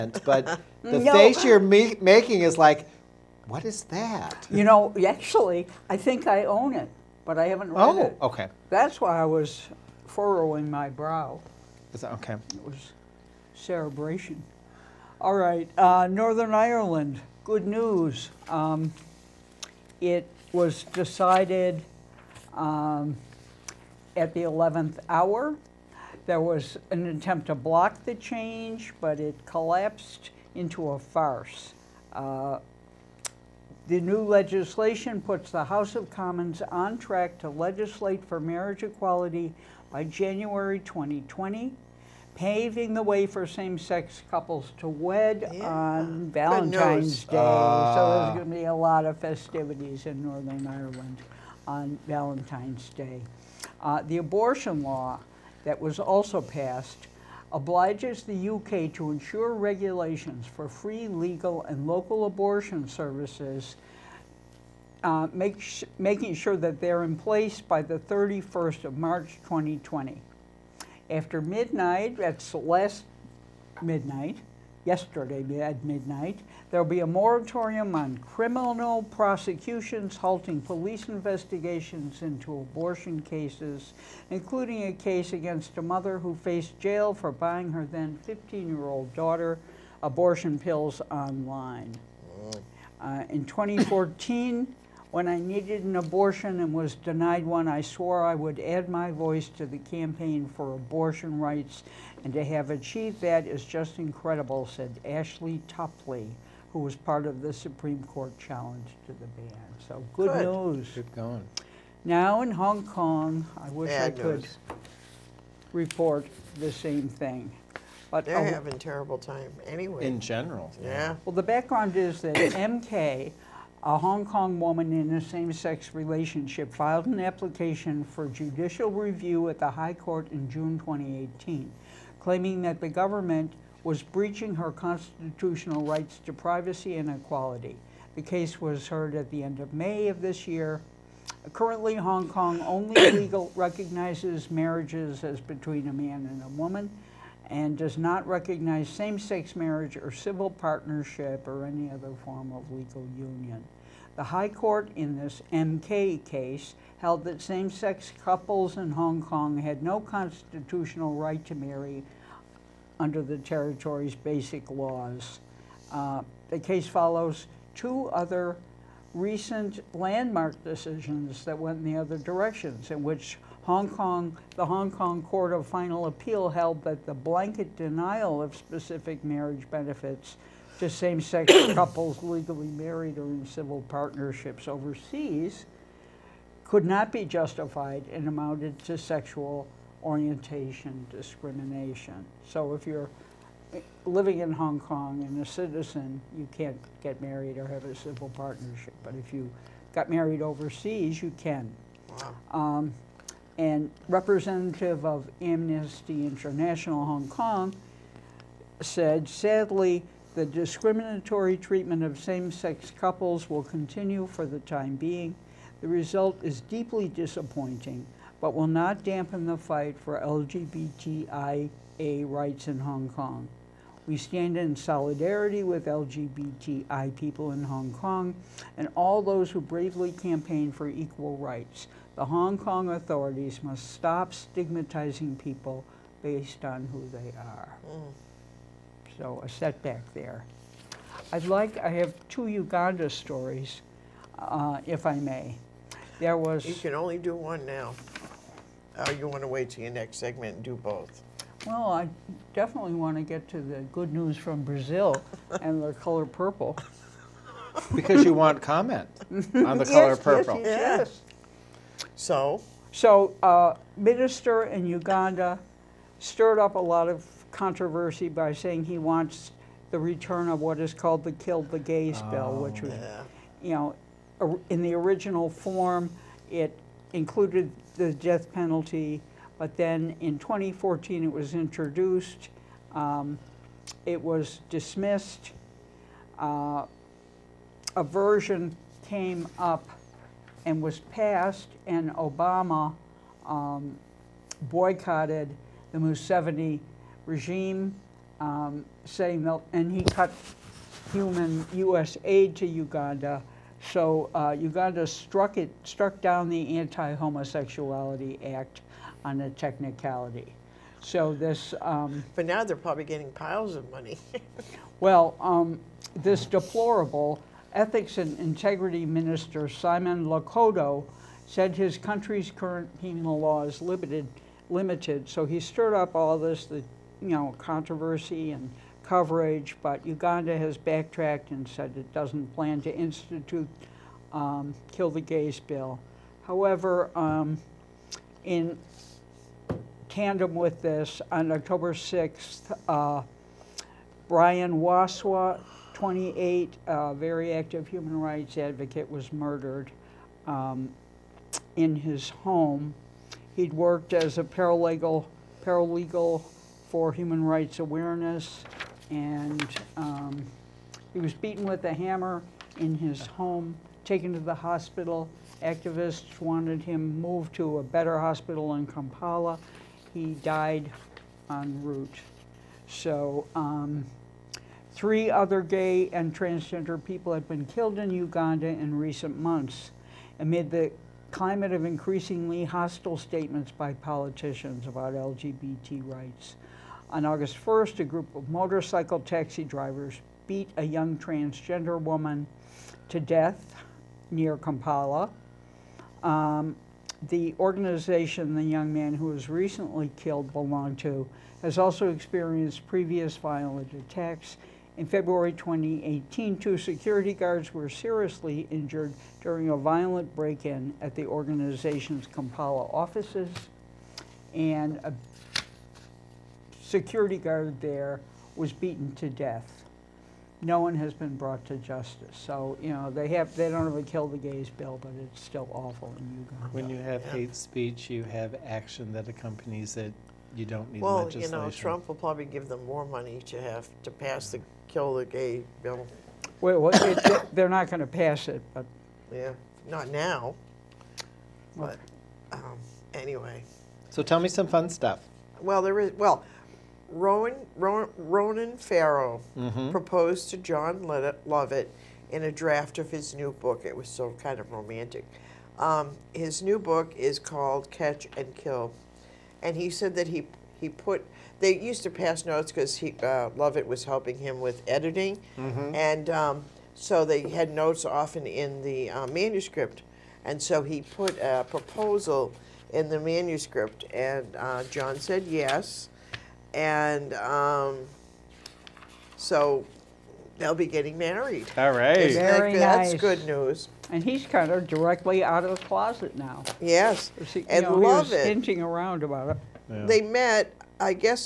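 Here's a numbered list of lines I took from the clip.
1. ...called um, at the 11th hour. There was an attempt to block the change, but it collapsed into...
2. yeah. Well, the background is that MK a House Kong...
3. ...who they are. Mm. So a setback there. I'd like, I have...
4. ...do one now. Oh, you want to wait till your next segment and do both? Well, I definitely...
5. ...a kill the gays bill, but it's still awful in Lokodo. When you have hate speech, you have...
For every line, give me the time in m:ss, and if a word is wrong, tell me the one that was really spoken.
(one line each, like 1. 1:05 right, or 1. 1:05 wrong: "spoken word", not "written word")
1. 0:20 wrong: "decided", not "called"
2. 2:00 wrong: "Hong", not "House"
3. 3:56 right
4. 4:07 right
5. 7:03 wrong: "Uganda", not "Lokodo".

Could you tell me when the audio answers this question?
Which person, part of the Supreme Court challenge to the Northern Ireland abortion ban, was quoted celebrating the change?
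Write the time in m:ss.
1:45.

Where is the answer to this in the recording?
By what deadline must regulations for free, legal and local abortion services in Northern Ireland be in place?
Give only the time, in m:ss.
1:07.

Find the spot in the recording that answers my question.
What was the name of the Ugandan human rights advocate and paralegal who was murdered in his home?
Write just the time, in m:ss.
5:44.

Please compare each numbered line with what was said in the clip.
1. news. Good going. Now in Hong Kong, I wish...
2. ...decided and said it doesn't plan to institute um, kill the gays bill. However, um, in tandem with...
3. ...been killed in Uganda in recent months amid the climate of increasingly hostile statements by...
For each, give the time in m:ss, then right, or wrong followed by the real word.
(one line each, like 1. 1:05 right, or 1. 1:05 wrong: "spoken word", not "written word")
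1. 1:50 right
2. 5:30 wrong: "backtracked", not "decided"
3. 6:17 right.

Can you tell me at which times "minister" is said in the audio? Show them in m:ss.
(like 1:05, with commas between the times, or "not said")
4:23, 5:19.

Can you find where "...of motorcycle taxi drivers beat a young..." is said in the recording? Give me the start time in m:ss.
6:28.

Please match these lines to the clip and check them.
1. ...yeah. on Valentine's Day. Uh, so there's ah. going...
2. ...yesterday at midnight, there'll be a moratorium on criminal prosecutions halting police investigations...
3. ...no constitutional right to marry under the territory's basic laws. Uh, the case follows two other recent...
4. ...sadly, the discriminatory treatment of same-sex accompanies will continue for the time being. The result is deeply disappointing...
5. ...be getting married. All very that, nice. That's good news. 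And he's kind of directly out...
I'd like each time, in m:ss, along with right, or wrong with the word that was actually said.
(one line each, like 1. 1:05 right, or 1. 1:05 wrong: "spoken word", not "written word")
1. 0:45 right
2. 1:14 right
3. 2:39 right
4. 3:29 wrong: "couples", not "accompanies"
5. 8:00 right.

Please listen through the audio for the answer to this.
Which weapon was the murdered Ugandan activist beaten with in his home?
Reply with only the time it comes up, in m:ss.
6:01.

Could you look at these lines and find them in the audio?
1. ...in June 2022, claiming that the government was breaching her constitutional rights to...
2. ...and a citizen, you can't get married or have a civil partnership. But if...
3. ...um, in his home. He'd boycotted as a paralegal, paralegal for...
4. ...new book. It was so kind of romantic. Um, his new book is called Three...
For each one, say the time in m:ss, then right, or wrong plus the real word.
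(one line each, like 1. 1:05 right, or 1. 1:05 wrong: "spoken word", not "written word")
1. 2:10 wrong: "2018", not "2022"
2. 3:15 right
3. 5:50 wrong: "worked", not "boycotted"
4. 7:33 wrong: "Catch", not "Three".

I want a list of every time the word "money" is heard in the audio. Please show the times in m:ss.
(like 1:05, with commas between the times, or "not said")
5:13, 7:13.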